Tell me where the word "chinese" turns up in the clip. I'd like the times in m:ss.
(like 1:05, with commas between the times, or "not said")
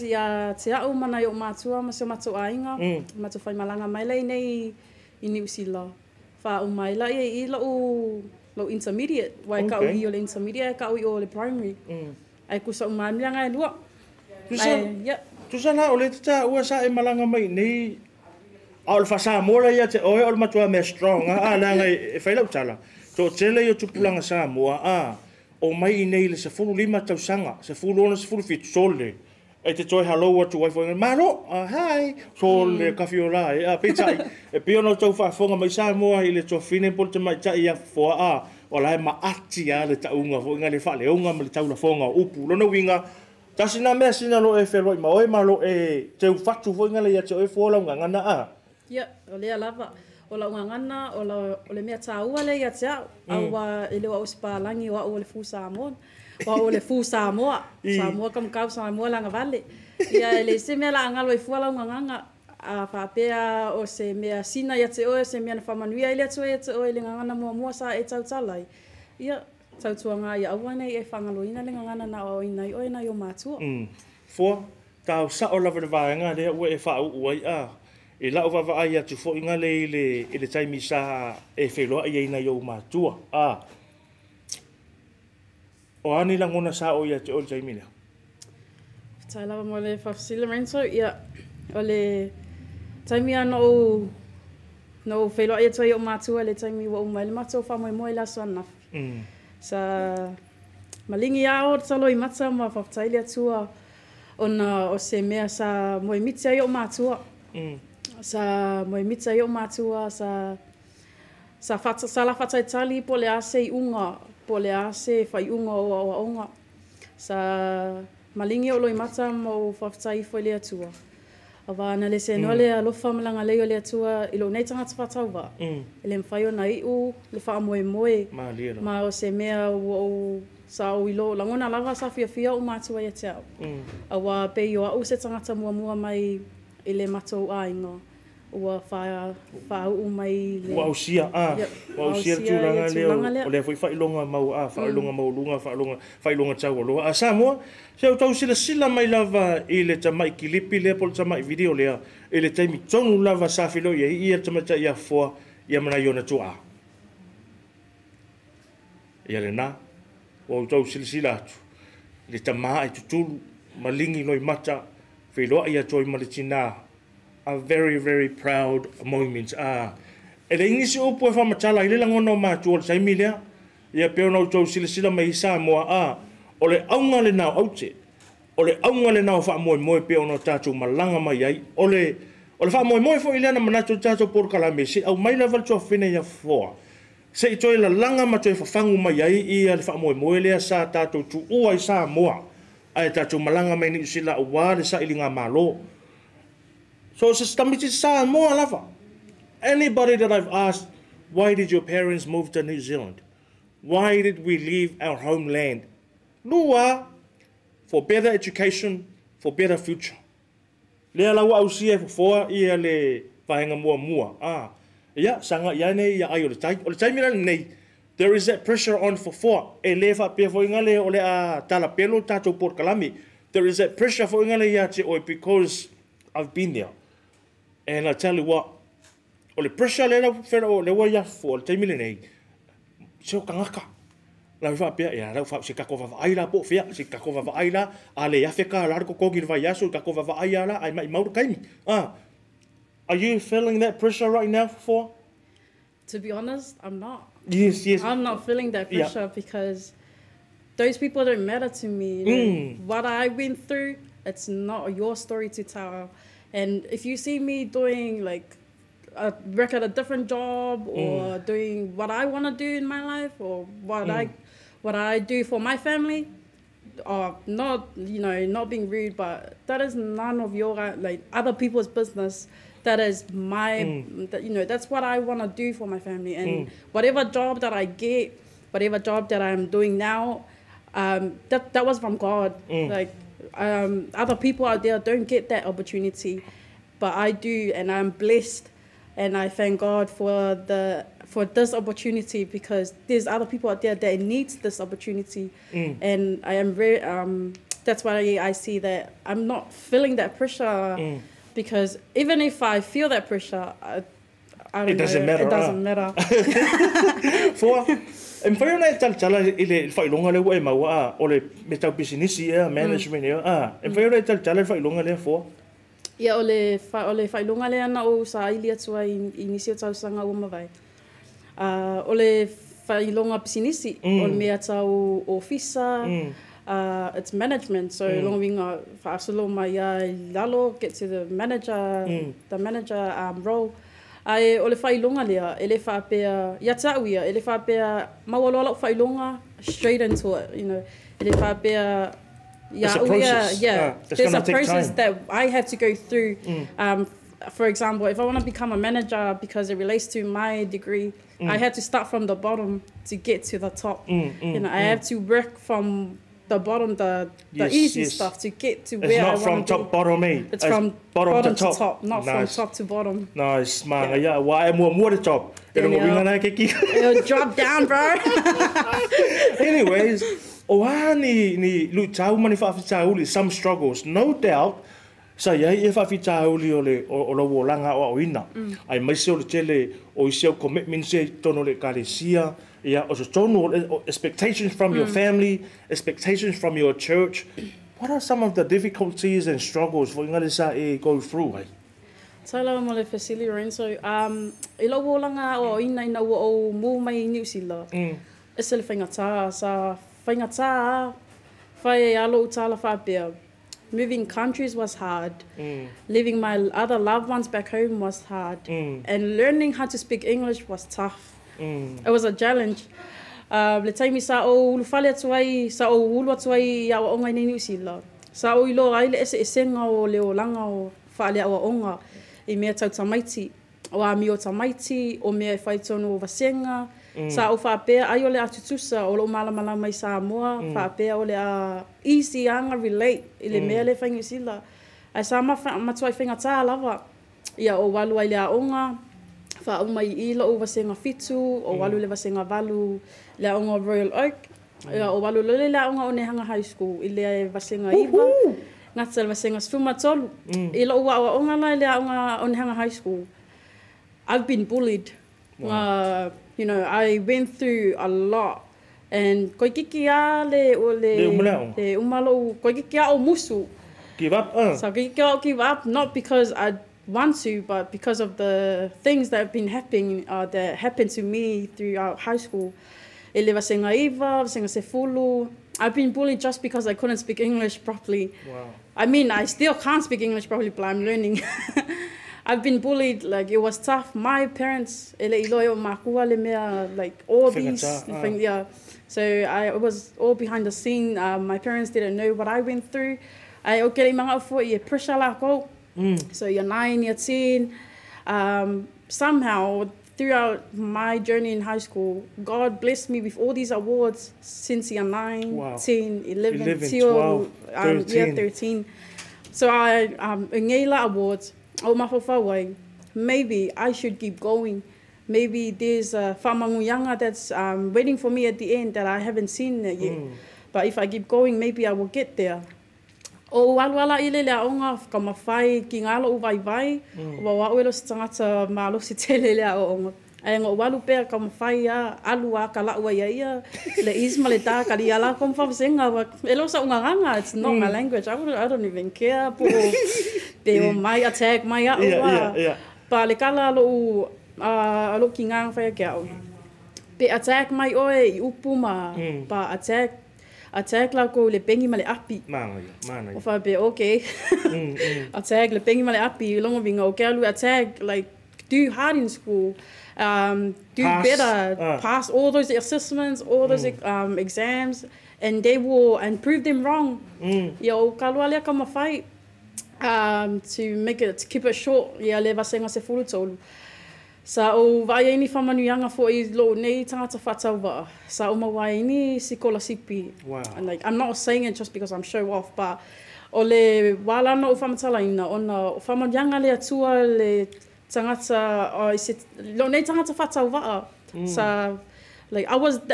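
not said.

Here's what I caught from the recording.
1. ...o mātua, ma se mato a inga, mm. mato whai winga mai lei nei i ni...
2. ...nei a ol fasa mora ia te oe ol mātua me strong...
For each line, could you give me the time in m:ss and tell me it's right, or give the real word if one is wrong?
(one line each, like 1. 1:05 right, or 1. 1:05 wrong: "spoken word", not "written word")
1. 0:01 wrong: "malanga", not "winga"
2. 0:17 wrong: "matua", not "mātua".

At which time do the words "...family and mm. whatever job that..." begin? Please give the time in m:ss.
4:36.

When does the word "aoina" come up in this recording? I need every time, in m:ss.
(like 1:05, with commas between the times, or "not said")
6:18.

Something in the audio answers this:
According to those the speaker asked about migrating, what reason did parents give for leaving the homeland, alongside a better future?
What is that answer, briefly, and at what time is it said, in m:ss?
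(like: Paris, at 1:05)
better education, at 3:27.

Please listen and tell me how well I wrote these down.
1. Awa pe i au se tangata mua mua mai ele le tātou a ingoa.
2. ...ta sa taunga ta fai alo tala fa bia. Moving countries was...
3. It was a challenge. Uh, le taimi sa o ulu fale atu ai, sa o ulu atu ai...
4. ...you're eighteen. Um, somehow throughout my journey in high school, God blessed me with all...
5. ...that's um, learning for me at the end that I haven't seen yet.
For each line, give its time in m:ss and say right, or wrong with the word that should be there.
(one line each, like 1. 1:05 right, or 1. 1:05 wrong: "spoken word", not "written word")
1. 2:14 wrong: "matou", not "tātou"
2. 6:39 wrong: "fenga", not "taunga"
3. 6:52 right
4. 8:17 wrong: "ten", not "eighteen"
5. 8:37 wrong: "waiting", not "learning".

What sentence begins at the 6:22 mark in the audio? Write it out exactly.
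Yeah, eh, oh, expectations from mm.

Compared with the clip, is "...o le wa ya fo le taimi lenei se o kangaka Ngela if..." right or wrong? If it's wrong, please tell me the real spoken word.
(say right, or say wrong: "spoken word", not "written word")
wrong: "Now", not "Ngela".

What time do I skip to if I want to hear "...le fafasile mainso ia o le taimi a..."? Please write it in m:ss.
1:29.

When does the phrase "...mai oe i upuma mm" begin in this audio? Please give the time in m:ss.
9:07.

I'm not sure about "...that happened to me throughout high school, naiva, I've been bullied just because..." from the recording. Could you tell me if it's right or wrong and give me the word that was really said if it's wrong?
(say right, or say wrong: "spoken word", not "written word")
right.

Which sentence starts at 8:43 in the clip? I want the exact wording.
o walwala ile le onga ka mafai ki ngalo u vai vai mm.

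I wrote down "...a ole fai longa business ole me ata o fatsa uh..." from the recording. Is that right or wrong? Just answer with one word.
wrong.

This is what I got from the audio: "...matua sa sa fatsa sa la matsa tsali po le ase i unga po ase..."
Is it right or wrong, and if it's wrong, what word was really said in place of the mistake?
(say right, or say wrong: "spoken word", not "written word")
wrong: "fatsa", not "matsa".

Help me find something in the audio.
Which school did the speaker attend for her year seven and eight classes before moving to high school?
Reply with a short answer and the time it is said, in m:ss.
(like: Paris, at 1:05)
Royal Oak, at 7:23.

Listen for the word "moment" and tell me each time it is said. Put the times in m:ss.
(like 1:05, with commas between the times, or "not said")
2:49.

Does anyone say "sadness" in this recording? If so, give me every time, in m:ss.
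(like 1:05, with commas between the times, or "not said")
not said.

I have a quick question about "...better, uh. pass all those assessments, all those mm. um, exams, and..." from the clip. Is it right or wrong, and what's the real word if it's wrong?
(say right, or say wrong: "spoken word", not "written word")
right.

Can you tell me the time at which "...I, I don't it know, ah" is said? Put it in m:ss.
5:03.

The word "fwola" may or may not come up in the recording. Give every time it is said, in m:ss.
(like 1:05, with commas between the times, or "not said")
0:47, 1:01.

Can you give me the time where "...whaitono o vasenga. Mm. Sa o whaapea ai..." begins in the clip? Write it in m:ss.
7:05.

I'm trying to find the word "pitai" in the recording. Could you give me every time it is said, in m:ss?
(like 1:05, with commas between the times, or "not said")
0:33.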